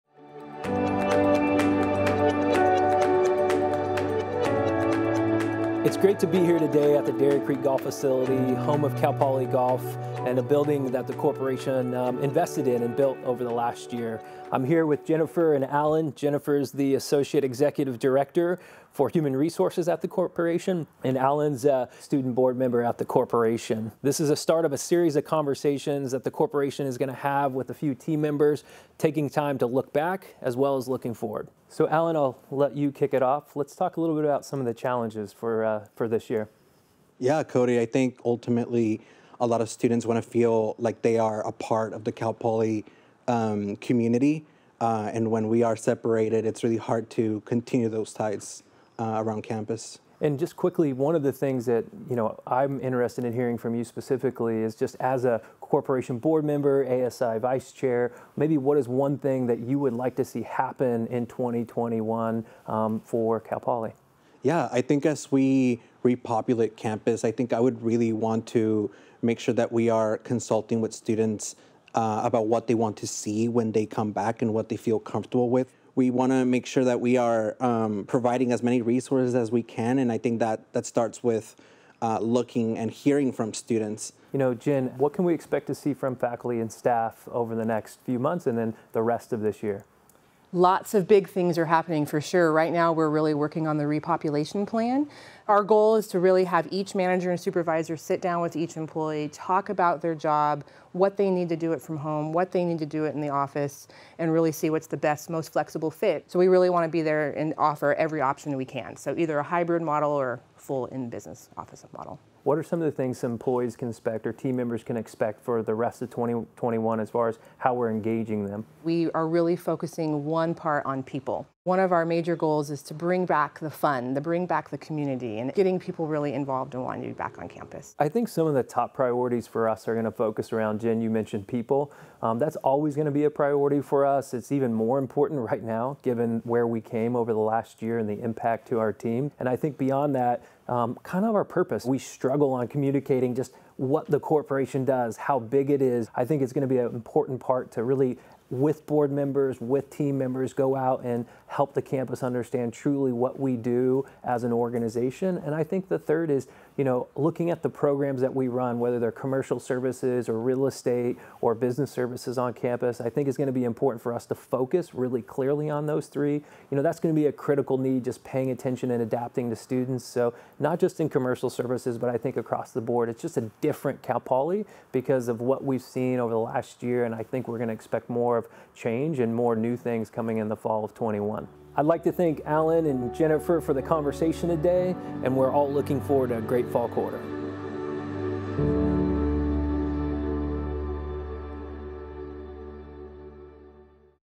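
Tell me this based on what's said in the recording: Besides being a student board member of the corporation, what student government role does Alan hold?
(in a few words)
ASI vice chair.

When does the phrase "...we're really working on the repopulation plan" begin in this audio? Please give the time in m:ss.
1:32.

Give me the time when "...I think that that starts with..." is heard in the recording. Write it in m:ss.
1:20.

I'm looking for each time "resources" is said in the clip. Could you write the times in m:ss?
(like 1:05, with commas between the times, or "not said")
0:19, 1:18.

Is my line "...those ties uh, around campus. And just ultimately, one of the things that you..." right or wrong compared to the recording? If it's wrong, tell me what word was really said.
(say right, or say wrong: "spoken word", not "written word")
wrong: "quickly", not "ultimately".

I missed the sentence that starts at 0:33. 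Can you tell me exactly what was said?
Let's talk a little bit about some of the challenges for.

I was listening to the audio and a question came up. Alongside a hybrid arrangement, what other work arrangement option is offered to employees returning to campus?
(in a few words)
full in business office model.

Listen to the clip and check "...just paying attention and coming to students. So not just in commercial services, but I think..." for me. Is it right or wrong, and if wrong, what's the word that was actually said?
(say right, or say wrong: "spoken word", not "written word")
wrong: "adapting", not "coming".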